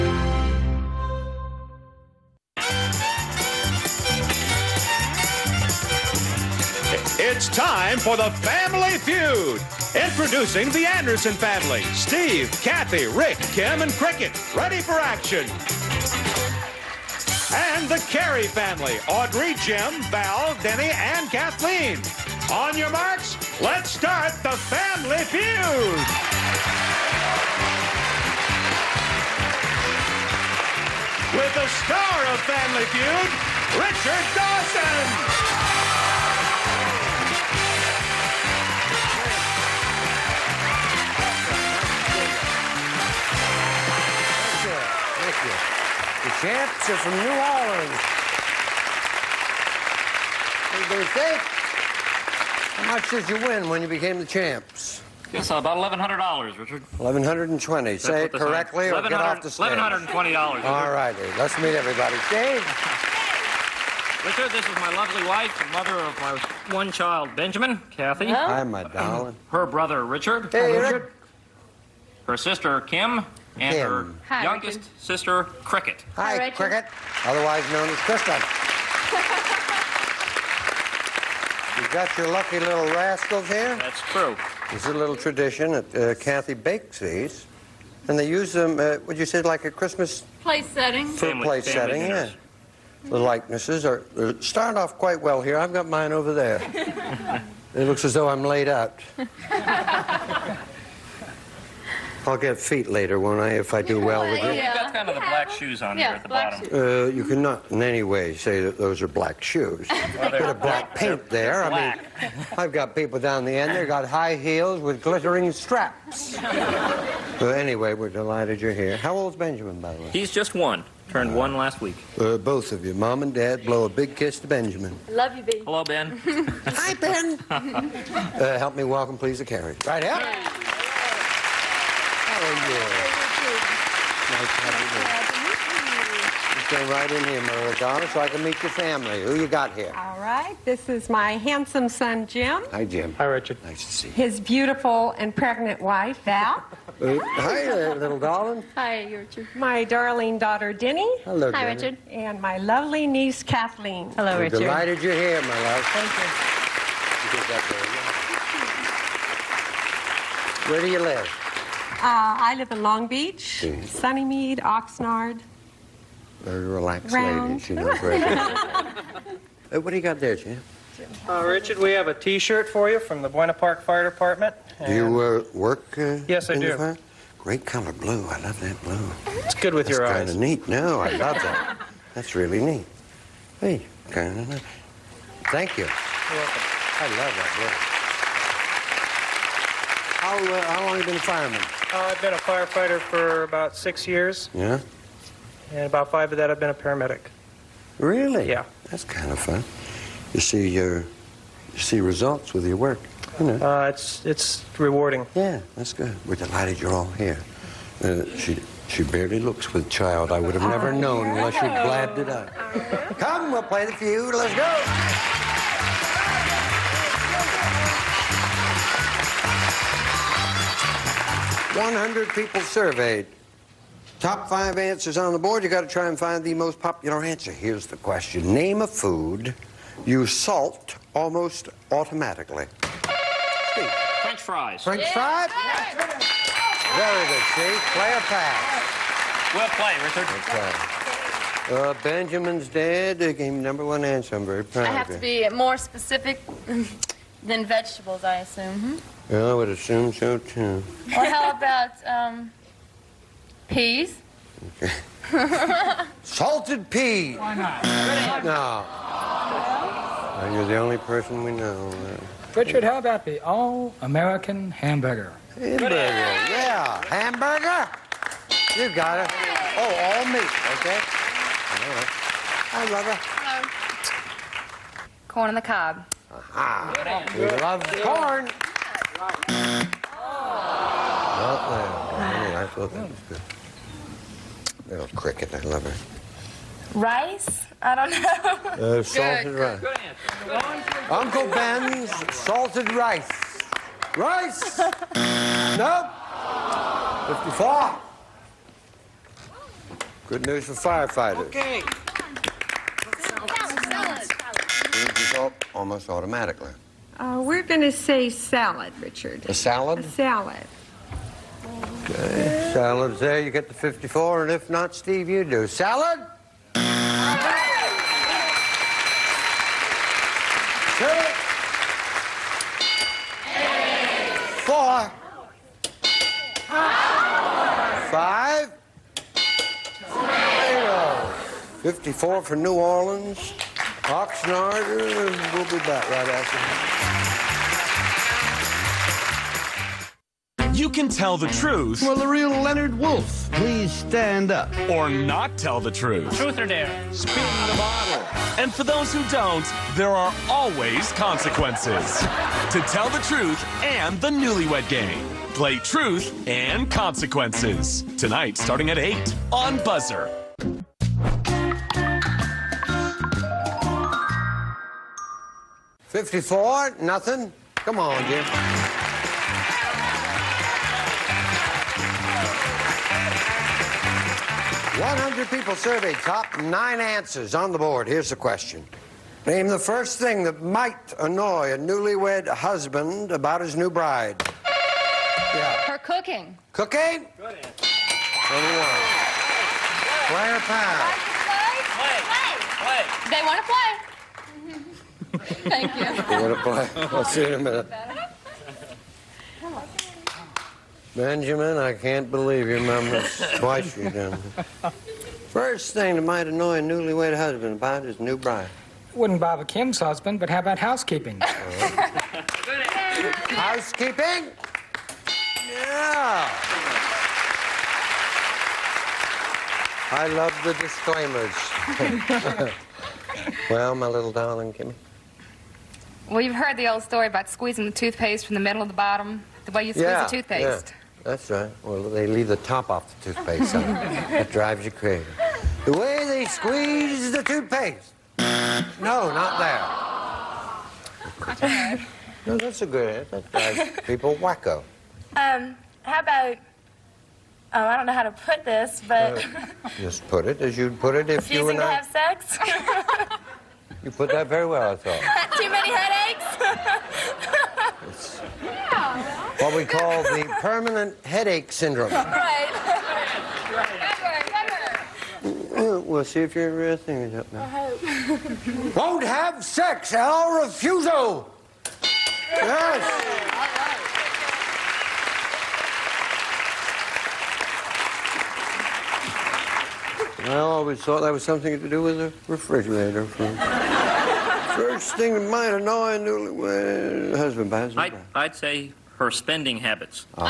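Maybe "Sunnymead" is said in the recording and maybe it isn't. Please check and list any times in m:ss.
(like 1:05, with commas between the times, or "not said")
2:43.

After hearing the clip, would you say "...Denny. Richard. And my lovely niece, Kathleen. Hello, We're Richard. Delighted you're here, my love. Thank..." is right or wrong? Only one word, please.
right.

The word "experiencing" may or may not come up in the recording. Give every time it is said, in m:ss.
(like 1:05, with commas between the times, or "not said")
not said.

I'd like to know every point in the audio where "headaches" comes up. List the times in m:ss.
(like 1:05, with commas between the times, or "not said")
7:35, 7:41.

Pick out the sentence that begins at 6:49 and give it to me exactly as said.
Wouldn't bother Kim's husband, but how about housekeeping?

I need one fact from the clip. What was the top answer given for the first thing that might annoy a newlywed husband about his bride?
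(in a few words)
Her cooking.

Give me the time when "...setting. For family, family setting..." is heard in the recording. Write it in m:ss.
1:30.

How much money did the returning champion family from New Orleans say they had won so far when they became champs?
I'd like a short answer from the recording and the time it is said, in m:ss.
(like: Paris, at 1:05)
$1,120, at 0:59.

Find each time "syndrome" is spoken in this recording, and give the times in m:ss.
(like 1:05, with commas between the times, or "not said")
7:41.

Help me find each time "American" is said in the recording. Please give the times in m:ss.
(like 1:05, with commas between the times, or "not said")
4:23.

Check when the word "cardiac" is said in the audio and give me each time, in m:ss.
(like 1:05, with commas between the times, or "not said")
not said.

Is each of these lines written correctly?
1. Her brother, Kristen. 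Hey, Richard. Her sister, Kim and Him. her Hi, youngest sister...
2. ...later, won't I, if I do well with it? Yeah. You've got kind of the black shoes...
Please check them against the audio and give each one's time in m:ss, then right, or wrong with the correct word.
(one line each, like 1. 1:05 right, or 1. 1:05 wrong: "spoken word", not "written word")
1. 1:09 wrong: "Richard", not "Kristen"
2. 1:42 right.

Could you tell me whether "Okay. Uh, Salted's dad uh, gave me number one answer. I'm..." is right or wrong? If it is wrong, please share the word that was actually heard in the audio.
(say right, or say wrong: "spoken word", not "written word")
wrong: "Benjamin", not "Salted".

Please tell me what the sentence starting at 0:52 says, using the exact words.
How much did you win when you became the champs?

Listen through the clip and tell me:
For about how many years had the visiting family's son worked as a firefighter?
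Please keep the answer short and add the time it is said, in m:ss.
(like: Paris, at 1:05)
6, at 3:13.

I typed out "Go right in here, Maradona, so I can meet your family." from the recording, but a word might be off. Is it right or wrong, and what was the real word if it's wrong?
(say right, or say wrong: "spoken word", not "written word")
right.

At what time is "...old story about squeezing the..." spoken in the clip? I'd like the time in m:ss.
7:06.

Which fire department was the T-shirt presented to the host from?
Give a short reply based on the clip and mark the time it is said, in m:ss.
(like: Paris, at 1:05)
Buena Park Fire Department, at 2:53.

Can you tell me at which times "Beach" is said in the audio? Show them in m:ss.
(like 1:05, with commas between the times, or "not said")
2:43.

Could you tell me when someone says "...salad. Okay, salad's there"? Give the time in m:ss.
5:10.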